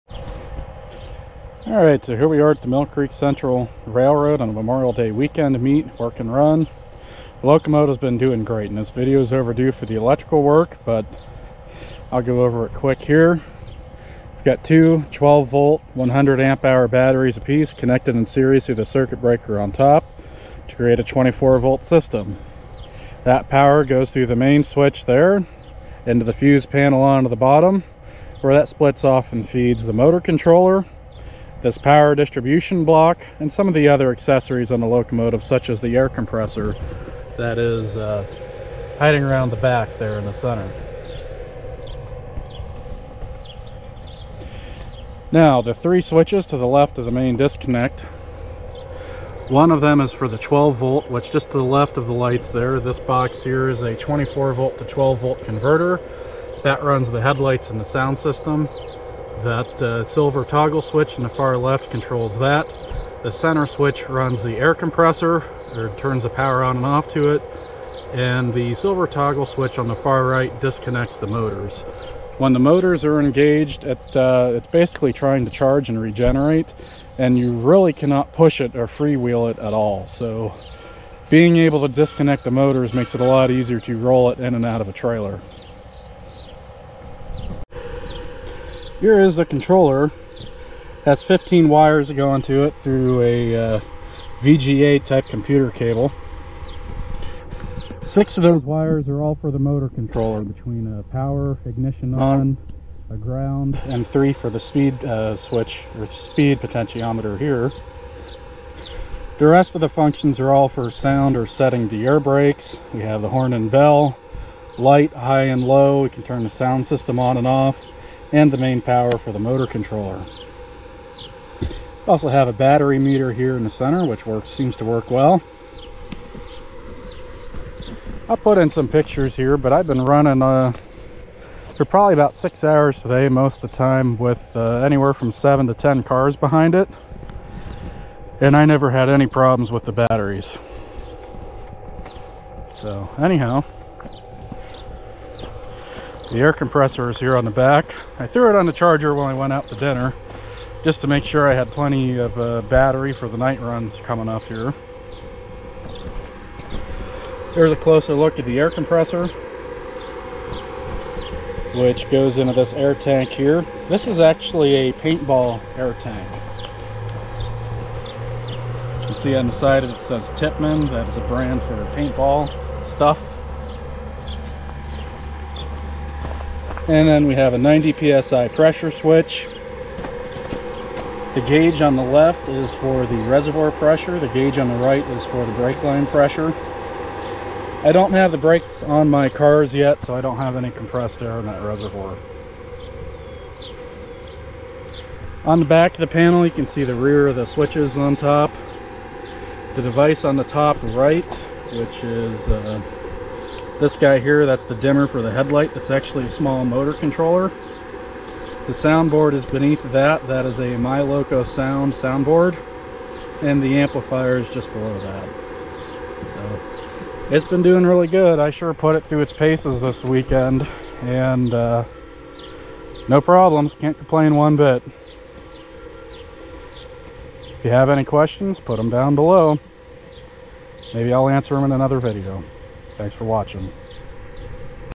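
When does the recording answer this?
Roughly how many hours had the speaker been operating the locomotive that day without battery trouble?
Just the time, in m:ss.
2:12.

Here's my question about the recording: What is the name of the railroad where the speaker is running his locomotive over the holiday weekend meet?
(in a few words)
Mill Creek Central Railroad.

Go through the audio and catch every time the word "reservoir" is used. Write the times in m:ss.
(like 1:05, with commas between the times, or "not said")
3:03, 3:11.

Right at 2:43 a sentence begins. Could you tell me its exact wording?
This is actually a paintball air tank.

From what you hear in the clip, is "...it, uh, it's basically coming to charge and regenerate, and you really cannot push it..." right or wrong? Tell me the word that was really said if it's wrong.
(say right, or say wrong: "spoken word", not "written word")
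wrong: "trying", not "coming".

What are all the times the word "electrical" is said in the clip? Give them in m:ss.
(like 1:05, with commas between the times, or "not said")
0:09.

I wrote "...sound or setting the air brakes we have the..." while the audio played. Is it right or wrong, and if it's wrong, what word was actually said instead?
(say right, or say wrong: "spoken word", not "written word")
right.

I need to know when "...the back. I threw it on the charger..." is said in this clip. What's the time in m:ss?
2:27.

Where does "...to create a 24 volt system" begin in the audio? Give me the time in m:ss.
0:20.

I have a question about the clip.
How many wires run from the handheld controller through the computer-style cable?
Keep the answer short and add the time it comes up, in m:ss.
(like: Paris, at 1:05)
15, at 1:31.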